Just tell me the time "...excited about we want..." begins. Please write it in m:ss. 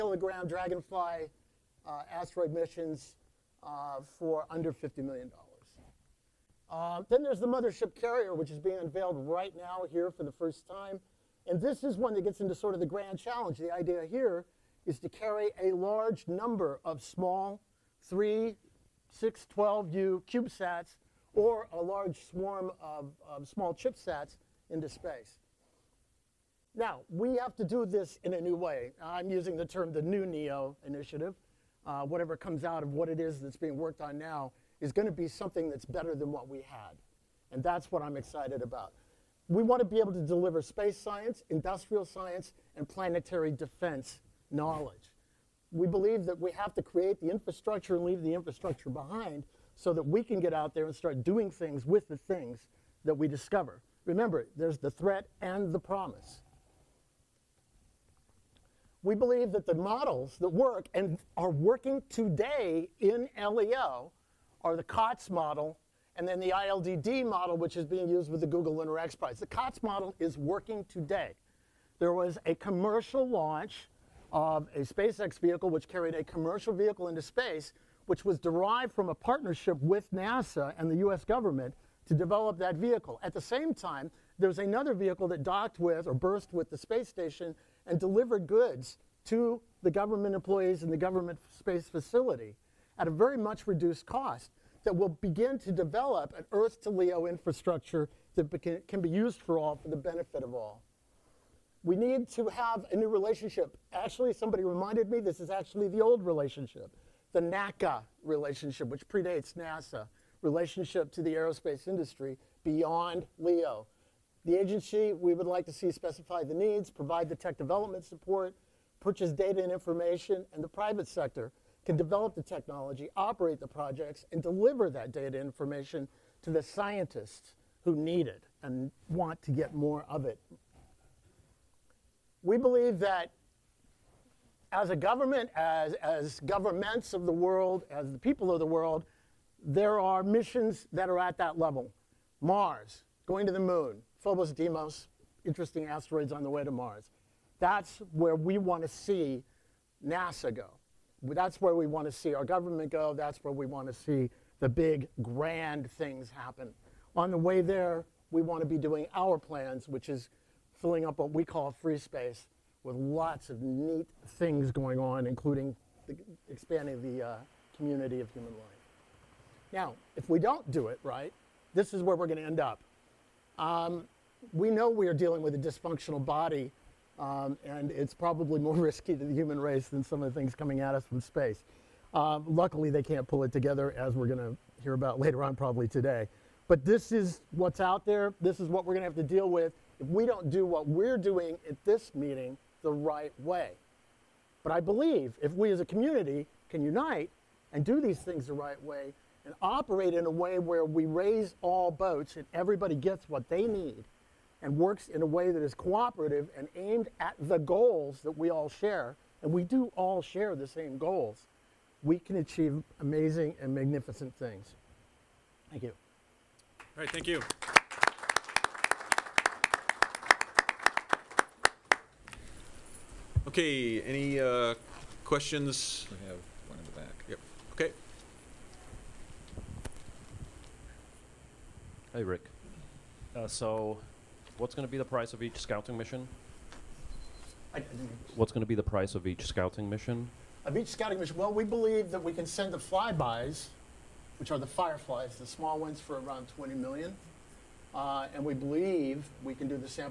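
0:38.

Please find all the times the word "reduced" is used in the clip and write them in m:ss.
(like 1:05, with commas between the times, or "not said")
1:33.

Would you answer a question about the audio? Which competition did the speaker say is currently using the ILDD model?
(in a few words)
Google Lunar X Prize.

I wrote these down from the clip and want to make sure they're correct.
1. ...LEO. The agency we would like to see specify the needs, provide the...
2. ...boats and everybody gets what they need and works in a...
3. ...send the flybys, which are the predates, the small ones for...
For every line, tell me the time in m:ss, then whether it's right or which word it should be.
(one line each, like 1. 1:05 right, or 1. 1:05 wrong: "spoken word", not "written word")
1. 1:53 right
2. 3:21 right
3. 4:02 wrong: "fireflies", not "predates".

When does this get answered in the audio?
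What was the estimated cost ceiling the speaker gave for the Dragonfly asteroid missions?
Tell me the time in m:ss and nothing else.
0:04.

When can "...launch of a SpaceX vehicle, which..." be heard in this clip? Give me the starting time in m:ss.
1:13.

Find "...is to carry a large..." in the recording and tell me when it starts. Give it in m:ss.
0:14.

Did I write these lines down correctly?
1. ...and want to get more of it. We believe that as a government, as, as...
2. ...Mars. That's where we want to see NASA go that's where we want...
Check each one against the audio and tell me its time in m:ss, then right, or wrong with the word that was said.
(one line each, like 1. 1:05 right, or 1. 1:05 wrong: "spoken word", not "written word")
1. 2:08 right
2. 2:26 right.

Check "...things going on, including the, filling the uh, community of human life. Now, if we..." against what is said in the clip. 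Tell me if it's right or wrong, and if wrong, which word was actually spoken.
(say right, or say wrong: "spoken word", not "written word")
wrong: "expanding", not "filling".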